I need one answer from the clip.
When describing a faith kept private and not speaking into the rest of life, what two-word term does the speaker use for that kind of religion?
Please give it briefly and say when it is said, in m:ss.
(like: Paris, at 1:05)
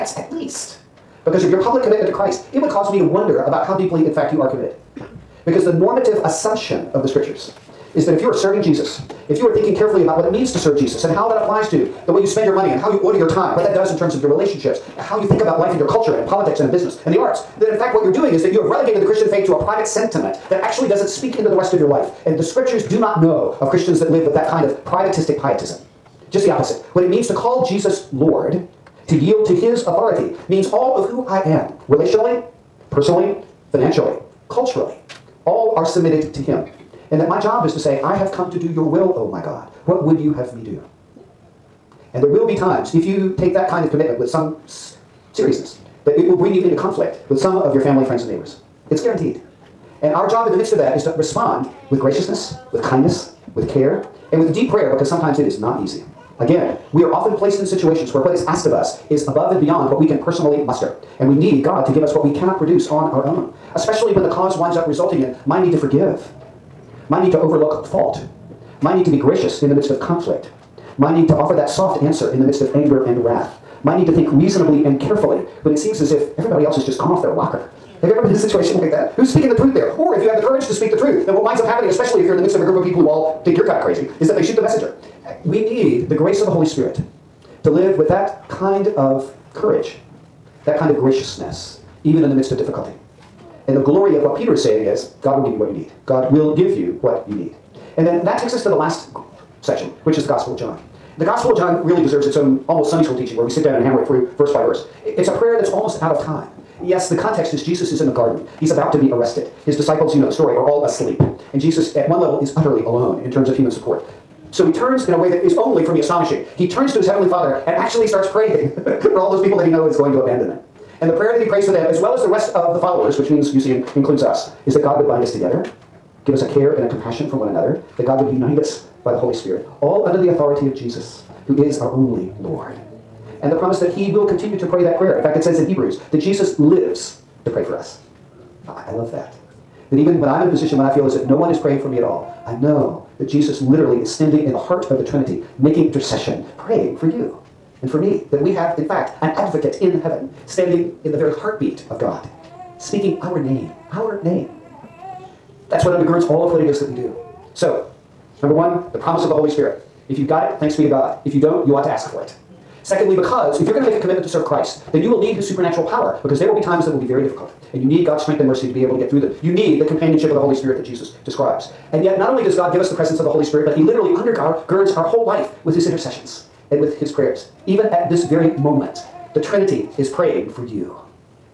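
privatistic pietism, at 0:24.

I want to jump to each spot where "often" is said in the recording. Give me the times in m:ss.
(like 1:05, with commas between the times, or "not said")
0:57.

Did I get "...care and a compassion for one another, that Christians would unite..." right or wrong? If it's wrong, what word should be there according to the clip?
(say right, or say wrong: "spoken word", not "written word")
wrong: "God", not "Christians".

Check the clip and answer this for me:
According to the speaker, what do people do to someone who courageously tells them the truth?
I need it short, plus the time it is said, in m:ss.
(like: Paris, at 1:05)
shoot the messenger, at 1:24.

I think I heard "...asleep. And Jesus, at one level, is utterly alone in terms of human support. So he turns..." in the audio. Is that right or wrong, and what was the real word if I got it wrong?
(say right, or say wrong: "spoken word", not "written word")
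right.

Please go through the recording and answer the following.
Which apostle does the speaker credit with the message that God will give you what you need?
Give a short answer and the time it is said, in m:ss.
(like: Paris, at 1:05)
Peter, at 1:34.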